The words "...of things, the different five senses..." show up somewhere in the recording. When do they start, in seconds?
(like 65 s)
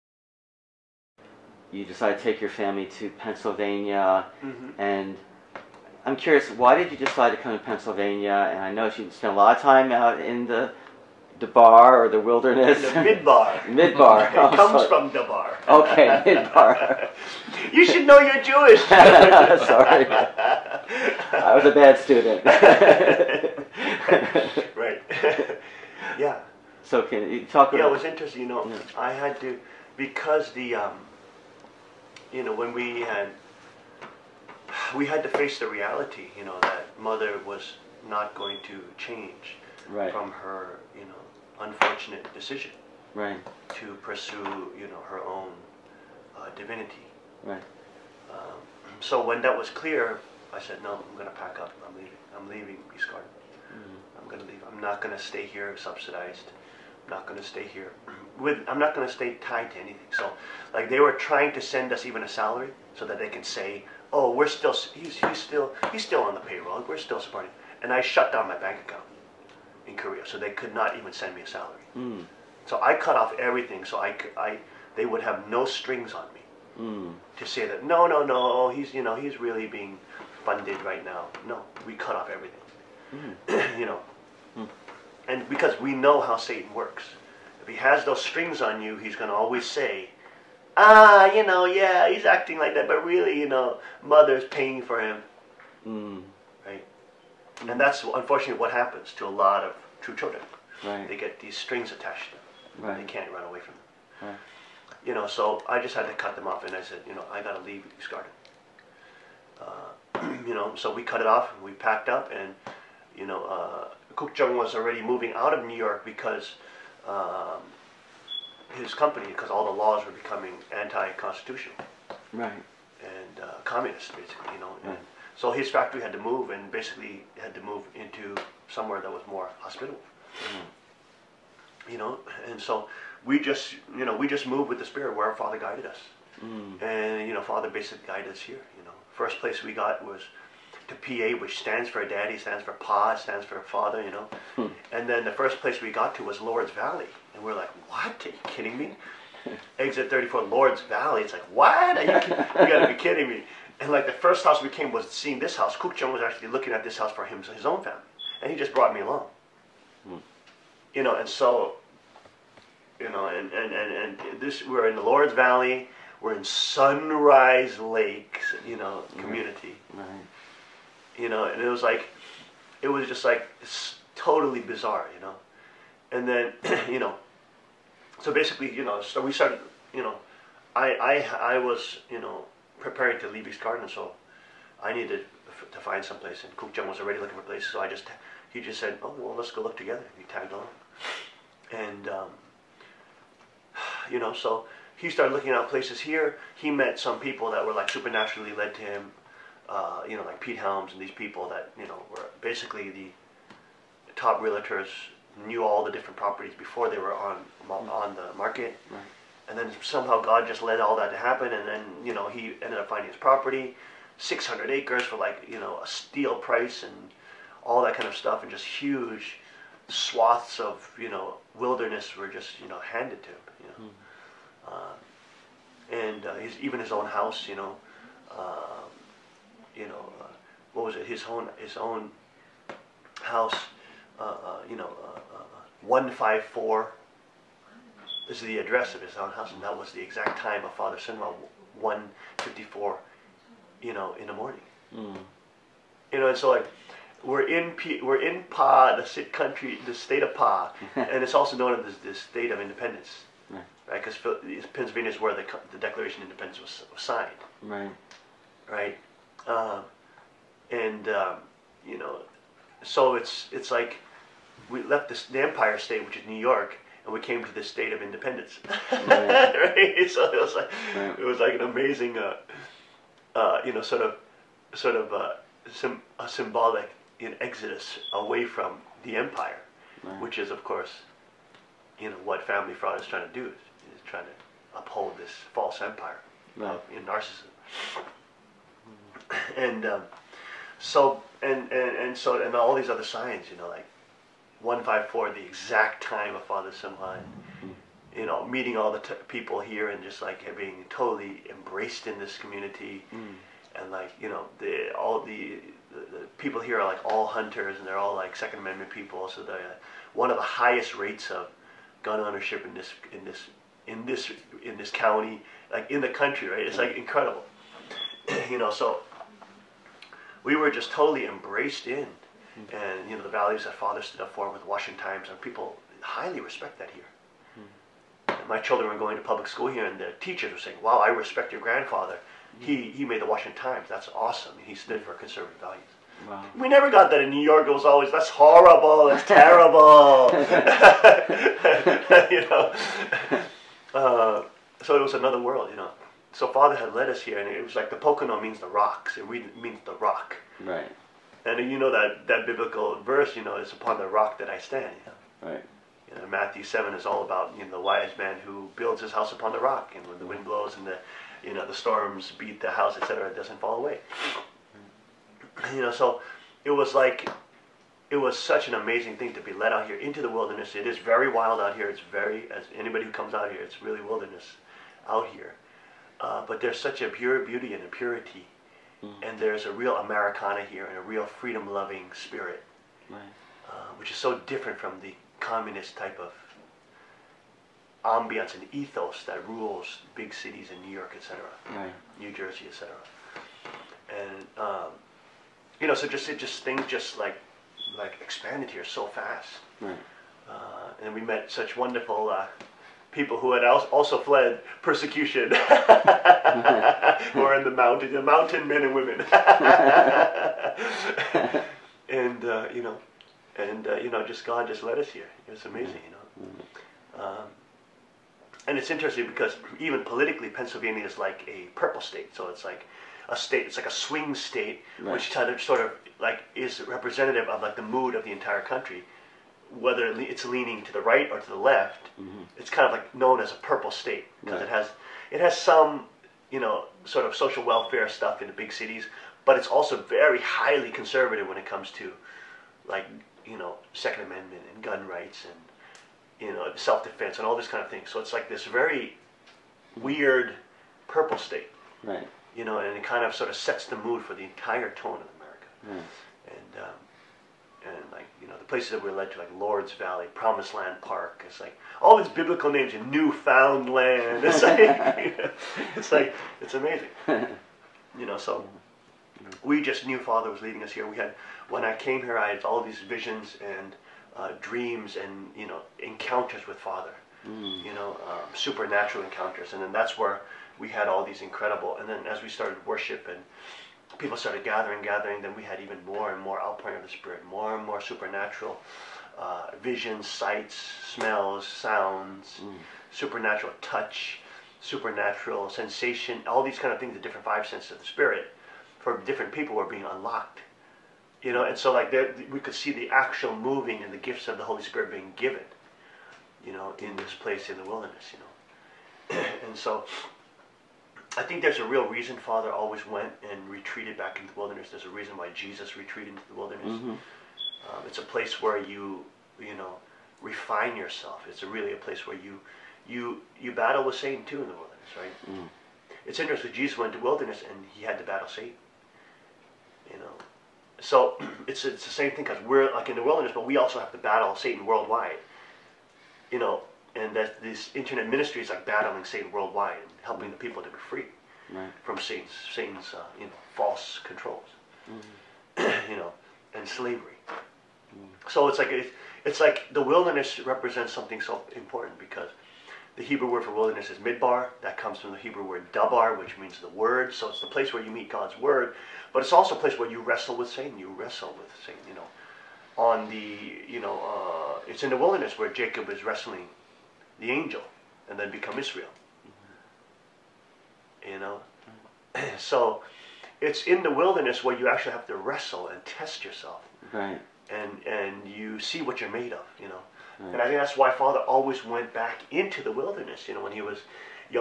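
496 s.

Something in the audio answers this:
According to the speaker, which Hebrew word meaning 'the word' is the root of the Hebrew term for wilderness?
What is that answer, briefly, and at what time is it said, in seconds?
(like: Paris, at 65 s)
dabar, at 555 s.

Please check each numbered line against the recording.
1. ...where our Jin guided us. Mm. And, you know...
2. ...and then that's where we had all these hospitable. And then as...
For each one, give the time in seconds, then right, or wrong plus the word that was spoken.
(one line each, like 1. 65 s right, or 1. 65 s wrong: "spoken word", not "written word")
1. 135 s wrong: "Father", not "Jin"
2. 479 s wrong: "incredible", not "hospitable".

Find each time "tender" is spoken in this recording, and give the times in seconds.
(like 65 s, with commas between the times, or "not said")
not said.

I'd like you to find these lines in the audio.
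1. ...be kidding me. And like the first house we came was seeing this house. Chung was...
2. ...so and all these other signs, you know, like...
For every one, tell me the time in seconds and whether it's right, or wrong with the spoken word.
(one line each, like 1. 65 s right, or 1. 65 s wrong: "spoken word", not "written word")
1. 152 s right
2. 292 s right.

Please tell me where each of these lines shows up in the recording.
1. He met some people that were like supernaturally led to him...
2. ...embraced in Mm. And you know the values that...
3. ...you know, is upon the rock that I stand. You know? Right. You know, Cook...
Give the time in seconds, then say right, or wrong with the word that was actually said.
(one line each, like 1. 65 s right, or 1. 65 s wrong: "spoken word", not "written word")
1. 196 s right
2. 321 s right
3. 353 s wrong: "Matthew", not "Cook".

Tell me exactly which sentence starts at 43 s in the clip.
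to pursue, you know, her own uh, divinity.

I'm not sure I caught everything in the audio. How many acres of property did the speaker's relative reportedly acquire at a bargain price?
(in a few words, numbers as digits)
600.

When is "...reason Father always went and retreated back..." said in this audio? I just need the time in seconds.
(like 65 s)
512 s.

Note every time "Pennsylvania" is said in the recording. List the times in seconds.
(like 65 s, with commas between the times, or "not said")
3 s, 7 s, 254 s, 420 s.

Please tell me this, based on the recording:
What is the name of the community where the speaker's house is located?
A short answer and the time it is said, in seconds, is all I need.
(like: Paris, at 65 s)
Sunrise Lakes, at 166 s.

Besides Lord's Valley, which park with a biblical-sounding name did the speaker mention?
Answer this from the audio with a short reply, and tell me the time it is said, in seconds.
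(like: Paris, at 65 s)
Promised Land Park, at 460 s.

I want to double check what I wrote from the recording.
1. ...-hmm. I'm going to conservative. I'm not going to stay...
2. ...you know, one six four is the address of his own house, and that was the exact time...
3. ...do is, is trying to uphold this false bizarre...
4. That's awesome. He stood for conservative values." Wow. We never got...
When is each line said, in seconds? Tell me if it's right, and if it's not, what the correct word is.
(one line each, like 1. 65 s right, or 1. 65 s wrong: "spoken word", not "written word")
1. 53 s wrong: "leave", not "conservative"
2. 234 s wrong: "five", not "six"
3. 283 s wrong: "empire", not "bizarre"
4. 333 s right.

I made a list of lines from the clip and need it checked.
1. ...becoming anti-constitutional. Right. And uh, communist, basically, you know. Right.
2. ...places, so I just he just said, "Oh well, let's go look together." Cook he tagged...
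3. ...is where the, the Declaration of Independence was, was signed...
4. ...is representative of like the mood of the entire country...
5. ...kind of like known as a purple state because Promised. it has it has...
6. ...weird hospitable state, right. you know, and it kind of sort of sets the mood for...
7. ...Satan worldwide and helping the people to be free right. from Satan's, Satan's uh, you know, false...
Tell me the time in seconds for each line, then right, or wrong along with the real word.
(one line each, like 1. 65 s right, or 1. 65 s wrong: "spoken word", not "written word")
1. 120 s right
2. 187 s wrong: "And", not "Cook"
3. 255 s right
4. 426 s right
5. 432 s wrong: "Right", not "Promised"
6. 450 s wrong: "purple", not "hospitable"
7. 539 s right.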